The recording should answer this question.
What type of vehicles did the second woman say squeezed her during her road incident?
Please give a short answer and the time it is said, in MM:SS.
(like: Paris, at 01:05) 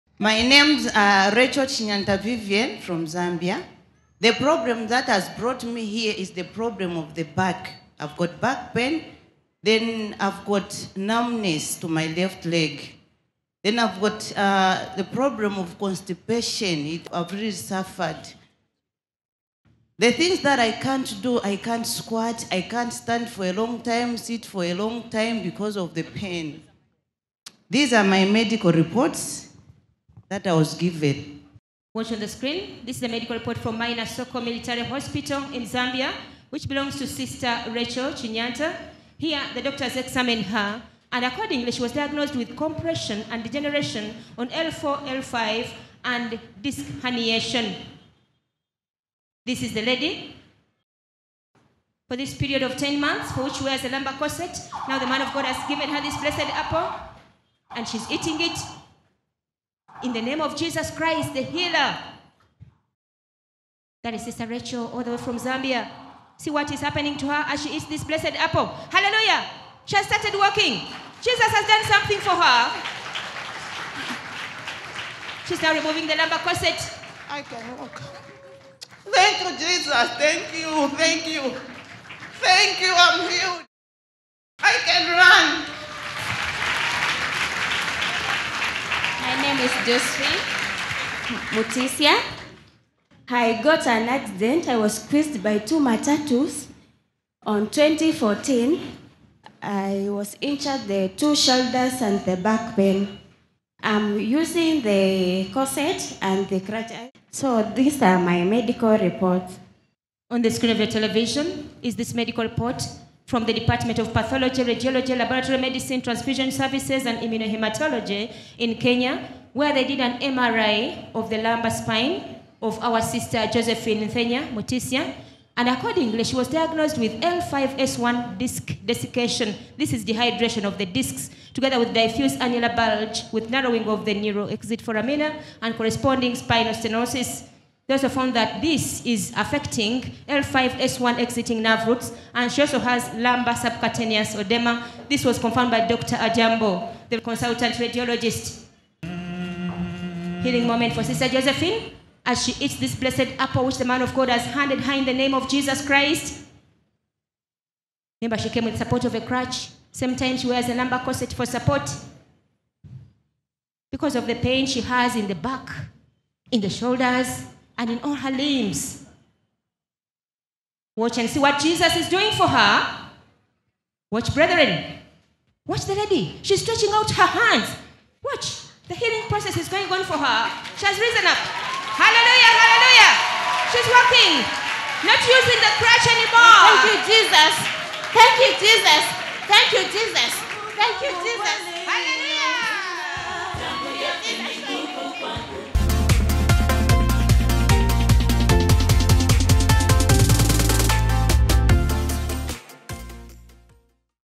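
Matatus, at 01:35.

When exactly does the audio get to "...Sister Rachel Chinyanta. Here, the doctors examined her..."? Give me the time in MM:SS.
00:37.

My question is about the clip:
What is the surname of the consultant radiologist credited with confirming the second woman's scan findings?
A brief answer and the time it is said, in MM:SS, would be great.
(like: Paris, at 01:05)
Ajambo, at 02:25.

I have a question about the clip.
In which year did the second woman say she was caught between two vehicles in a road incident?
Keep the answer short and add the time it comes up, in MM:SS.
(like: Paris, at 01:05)
2014, at 01:37.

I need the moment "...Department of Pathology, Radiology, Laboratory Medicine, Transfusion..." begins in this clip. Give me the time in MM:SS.
01:53.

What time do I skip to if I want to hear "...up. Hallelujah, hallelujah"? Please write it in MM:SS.
03:01.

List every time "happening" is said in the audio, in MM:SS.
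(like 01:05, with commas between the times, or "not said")
01:06.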